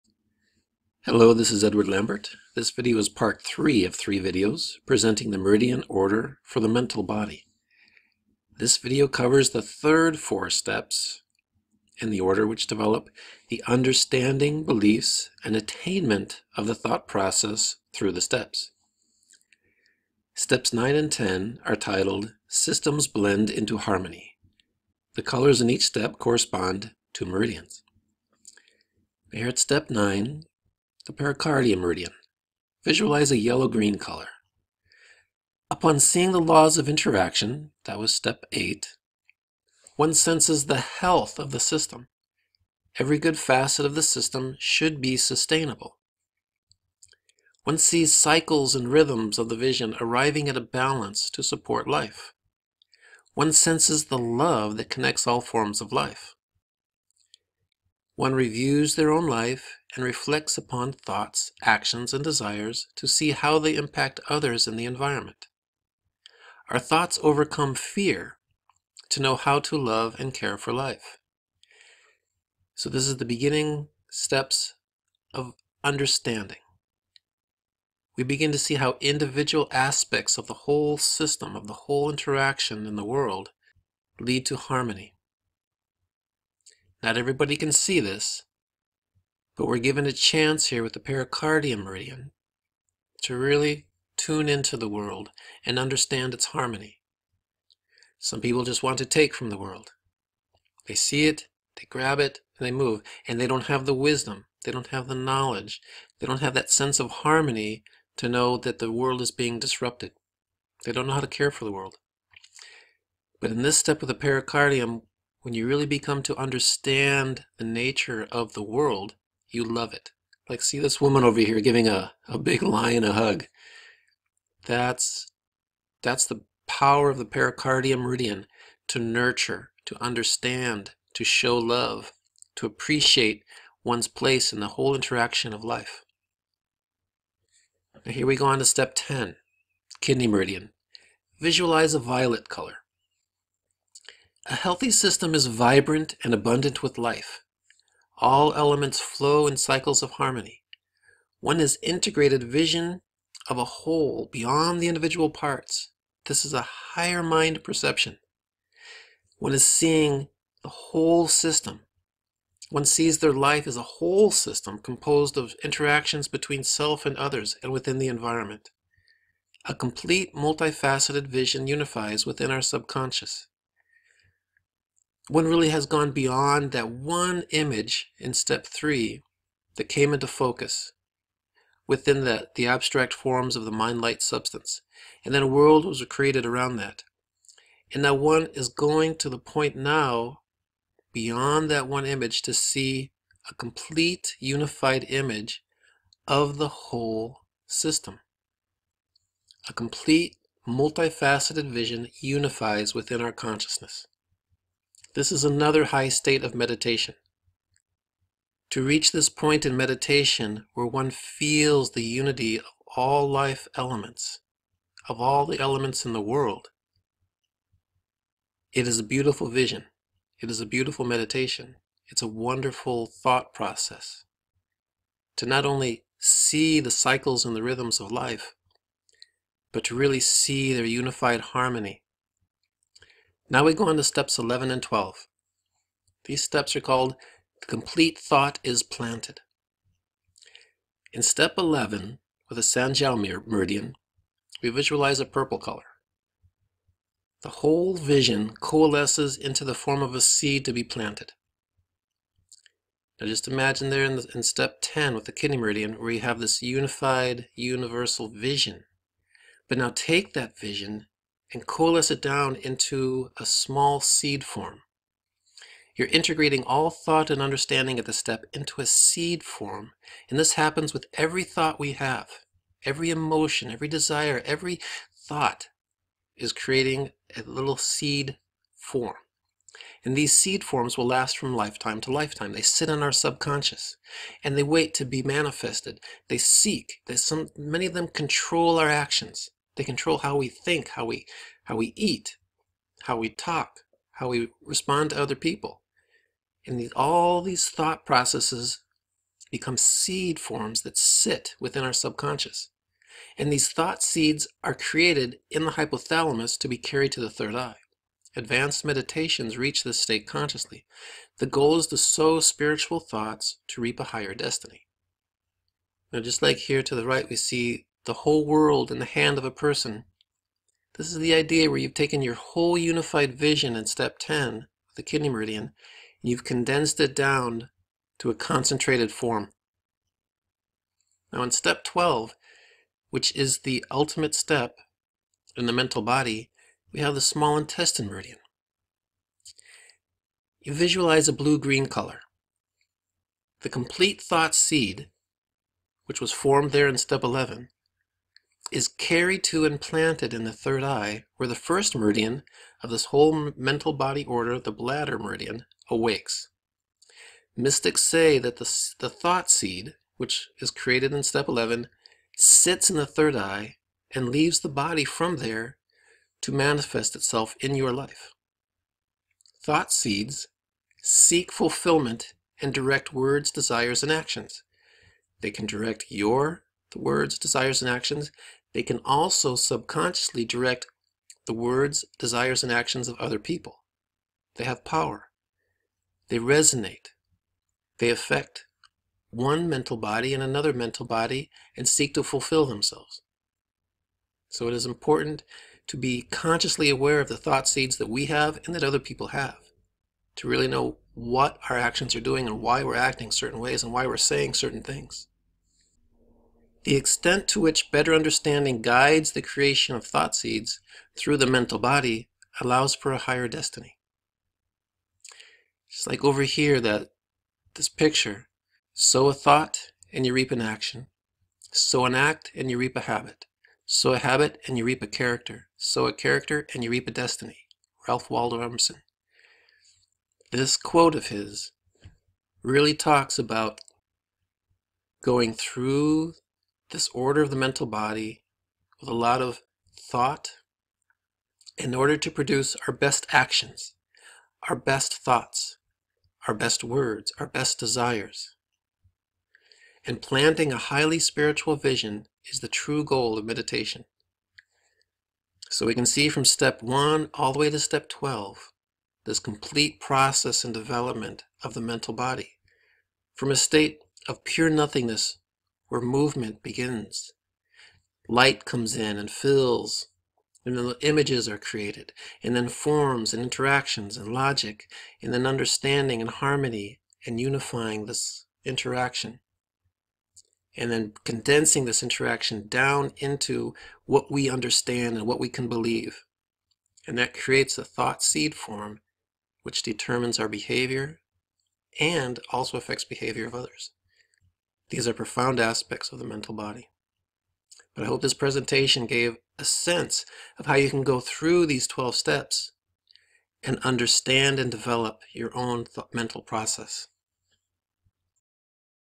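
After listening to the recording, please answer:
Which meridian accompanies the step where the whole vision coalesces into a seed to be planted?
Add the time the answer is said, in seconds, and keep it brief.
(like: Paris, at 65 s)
Sanjiao meridian, at 242 s.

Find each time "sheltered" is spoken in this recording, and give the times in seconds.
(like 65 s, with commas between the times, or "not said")
not said.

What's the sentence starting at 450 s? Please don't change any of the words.
And planting a highly spiritual vision is the true goal of meditation.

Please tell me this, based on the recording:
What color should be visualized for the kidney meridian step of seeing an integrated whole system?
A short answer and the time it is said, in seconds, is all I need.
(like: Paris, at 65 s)
Violet, at 141 s.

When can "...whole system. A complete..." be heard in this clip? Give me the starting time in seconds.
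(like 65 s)
196 s.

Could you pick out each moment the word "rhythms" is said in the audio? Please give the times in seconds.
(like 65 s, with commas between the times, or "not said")
48 s, 227 s.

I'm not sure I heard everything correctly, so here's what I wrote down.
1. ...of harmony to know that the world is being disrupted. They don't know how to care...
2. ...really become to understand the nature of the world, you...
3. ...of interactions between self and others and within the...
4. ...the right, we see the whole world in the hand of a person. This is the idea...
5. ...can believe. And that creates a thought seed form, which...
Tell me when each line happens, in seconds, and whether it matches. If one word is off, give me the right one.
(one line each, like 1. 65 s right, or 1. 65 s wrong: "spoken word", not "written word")
1. 106 s right
2. 115 s right
3. 165 s right
4. 316 s right
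5. 485 s right.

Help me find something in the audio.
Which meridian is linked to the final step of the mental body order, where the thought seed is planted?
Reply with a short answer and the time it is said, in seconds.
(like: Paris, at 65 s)
Small intestine meridian, at 337 s.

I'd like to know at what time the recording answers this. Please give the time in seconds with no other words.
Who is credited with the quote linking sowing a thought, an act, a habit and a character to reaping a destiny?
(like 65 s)
428 s.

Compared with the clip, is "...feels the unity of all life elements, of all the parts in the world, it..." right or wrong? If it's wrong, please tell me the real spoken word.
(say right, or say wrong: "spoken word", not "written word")
wrong: "elements", not "parts".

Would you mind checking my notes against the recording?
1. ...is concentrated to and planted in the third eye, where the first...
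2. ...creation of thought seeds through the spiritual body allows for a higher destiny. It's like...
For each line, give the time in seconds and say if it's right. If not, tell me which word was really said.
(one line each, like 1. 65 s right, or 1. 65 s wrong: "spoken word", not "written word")
1. 348 s wrong: "carried", not "concentrated"
2. 409 s wrong: "mental", not "spiritual".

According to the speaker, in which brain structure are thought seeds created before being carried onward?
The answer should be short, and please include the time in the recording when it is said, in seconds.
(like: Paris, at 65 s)
Hypothalamus, at 305 s.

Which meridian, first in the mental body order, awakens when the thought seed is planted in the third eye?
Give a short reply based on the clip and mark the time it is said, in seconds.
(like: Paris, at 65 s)
Bladder meridian, at 354 s.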